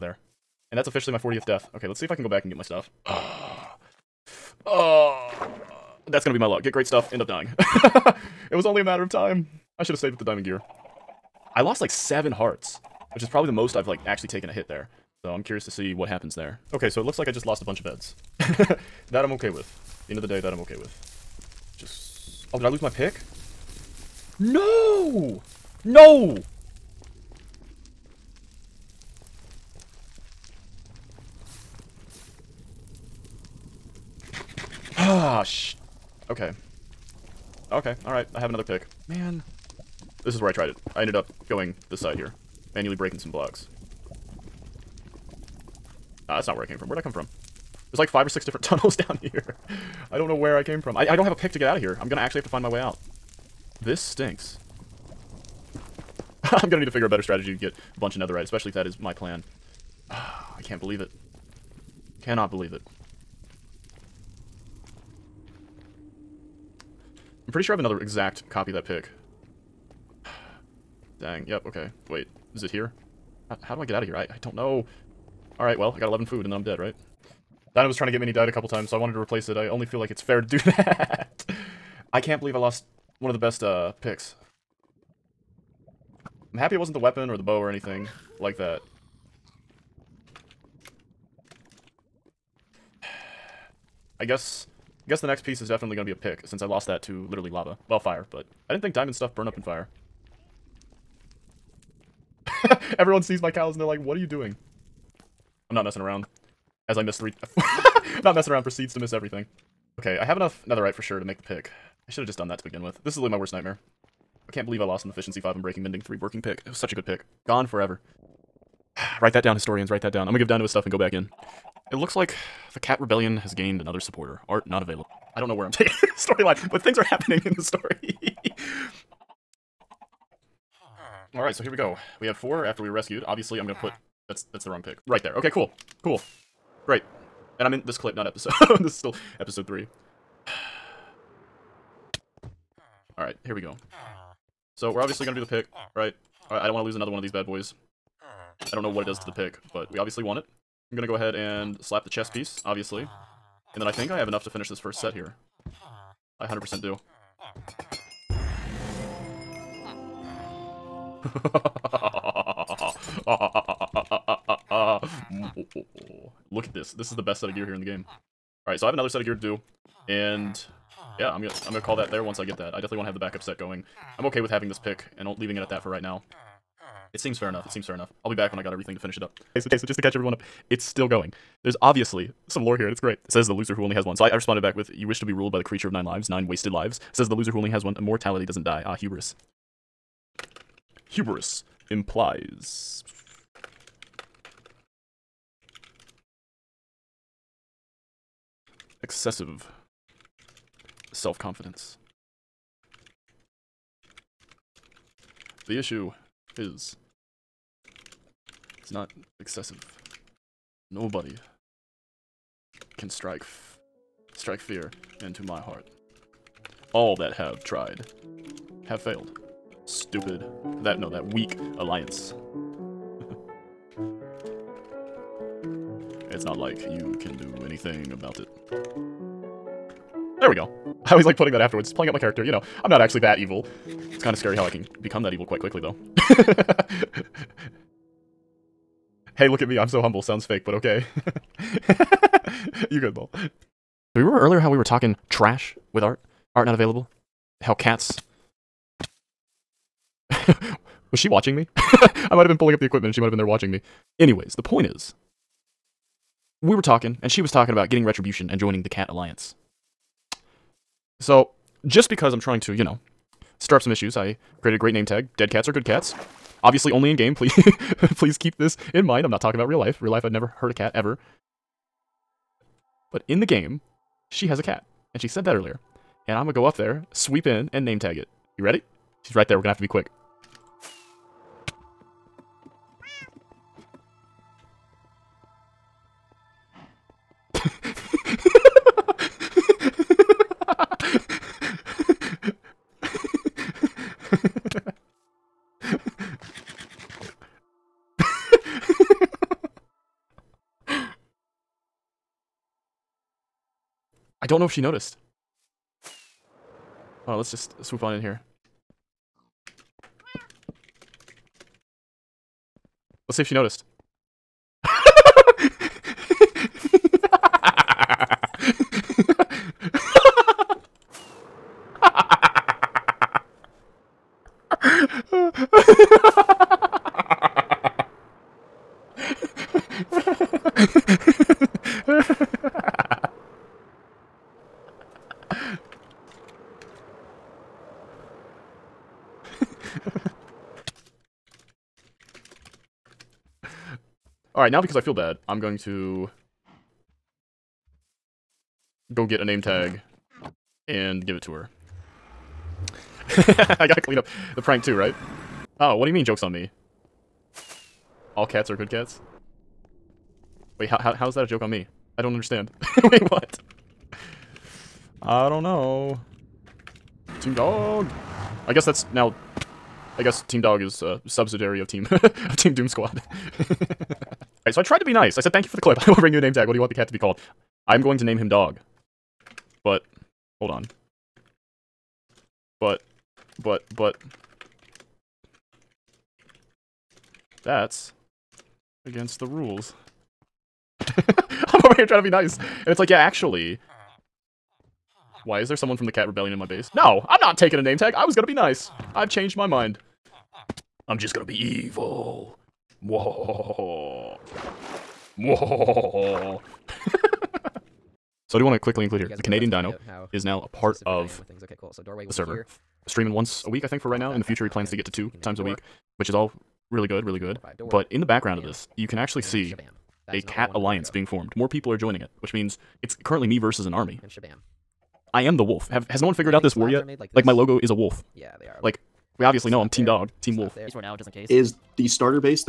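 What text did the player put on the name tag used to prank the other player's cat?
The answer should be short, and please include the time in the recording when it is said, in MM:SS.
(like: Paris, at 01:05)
Dead Cats are Good Cats, at 04:25.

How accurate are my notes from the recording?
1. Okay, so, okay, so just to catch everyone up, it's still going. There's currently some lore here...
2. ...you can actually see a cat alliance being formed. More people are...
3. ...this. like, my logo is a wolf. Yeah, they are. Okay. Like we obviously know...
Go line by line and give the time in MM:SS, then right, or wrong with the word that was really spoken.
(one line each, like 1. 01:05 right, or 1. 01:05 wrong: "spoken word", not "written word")
1. 02:59 wrong: "obviously", not "currently"
2. 06:58 right
3. 07:07 right.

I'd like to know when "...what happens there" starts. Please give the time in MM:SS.
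00:15.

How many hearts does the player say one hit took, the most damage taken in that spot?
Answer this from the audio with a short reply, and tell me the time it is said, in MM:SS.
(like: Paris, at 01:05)
7, at 00:11.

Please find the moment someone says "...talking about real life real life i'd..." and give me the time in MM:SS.
04:29.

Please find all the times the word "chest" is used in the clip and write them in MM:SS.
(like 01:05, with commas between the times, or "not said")
02:32.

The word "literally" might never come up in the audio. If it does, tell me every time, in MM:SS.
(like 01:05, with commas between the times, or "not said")
01:37, 01:53.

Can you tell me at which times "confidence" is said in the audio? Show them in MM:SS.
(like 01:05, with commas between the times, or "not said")
03:21.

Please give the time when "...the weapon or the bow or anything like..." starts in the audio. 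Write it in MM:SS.
01:26.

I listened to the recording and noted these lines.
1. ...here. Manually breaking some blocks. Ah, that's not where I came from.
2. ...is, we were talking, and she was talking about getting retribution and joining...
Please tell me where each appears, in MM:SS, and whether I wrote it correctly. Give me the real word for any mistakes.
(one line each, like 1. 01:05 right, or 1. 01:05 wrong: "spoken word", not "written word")
1. 00:42 right
2. 04:14 right.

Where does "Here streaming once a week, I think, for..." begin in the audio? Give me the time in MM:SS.
06:52.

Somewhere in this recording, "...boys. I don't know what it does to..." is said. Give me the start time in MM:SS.
02:27.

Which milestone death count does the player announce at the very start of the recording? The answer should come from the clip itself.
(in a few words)
40th.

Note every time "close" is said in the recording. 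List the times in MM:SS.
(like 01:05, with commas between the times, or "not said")
not said.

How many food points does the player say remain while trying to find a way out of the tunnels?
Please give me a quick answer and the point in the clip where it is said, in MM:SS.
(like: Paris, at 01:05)
11, at 01:16.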